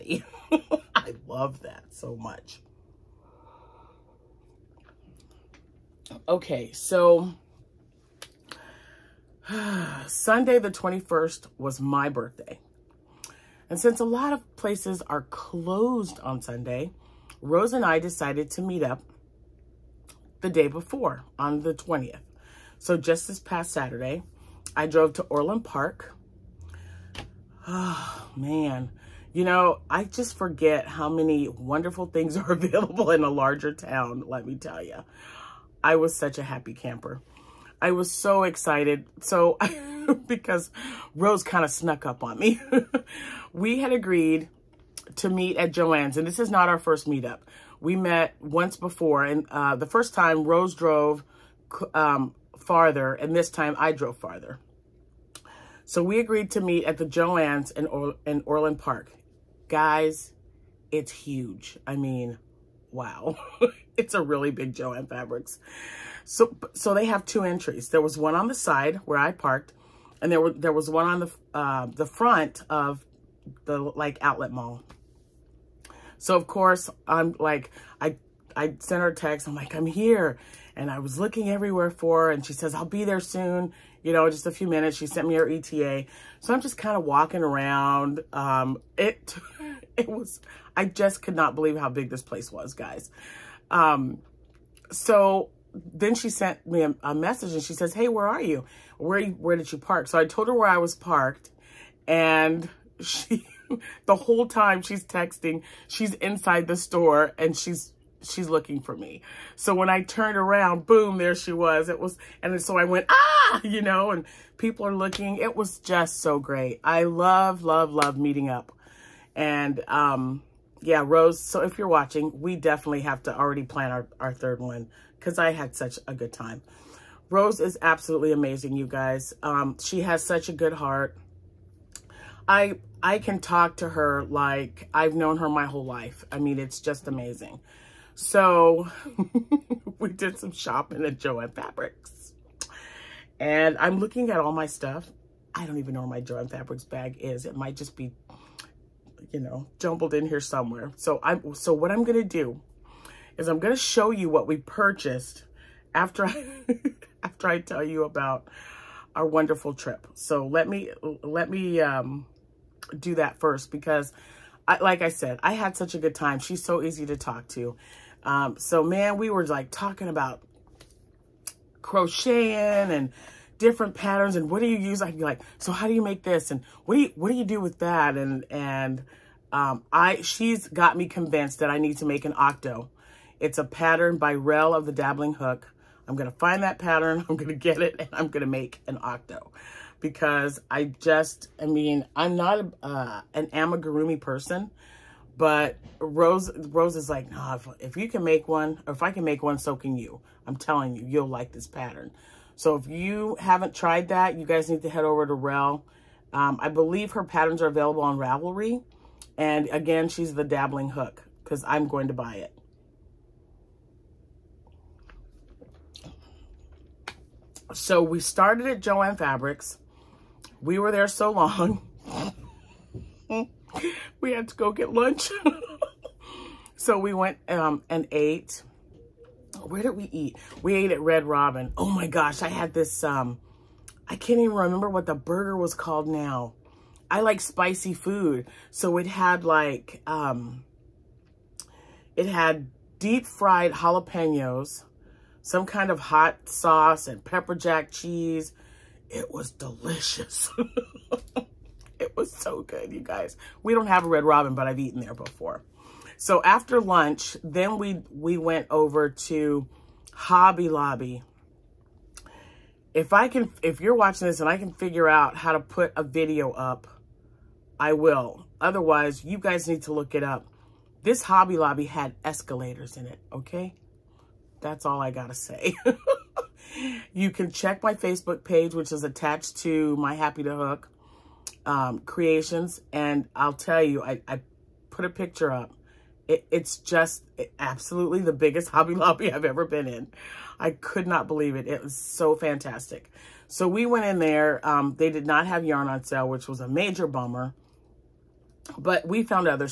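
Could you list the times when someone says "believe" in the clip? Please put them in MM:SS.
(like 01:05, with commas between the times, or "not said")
01:31, 03:26, 04:51.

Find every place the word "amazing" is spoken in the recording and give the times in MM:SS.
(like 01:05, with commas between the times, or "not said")
02:08, 02:17.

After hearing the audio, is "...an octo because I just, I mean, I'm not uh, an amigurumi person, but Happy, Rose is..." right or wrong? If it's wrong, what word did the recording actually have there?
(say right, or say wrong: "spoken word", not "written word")
wrong: "Rose", not "Happy".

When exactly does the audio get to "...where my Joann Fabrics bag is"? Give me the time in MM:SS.
02:26.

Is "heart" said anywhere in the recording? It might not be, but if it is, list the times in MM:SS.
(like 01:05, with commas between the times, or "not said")
02:10.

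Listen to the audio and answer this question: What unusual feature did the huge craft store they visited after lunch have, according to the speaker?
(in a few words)
Escalators.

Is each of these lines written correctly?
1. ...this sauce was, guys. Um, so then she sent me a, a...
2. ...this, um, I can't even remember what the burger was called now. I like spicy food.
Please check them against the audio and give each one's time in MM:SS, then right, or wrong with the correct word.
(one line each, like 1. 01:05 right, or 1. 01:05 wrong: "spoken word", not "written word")
1. 01:32 wrong: "place", not "sauce"
2. 03:52 right.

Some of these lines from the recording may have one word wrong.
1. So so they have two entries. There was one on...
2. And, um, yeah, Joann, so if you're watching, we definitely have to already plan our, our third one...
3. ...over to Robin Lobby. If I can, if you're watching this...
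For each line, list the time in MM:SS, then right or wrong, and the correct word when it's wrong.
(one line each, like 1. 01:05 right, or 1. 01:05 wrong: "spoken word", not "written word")
1. 01:06 right
2. 01:59 wrong: "Rose", not "Joann"
3. 04:18 wrong: "Hobby", not "Robin".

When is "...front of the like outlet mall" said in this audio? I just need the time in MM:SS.
01:12.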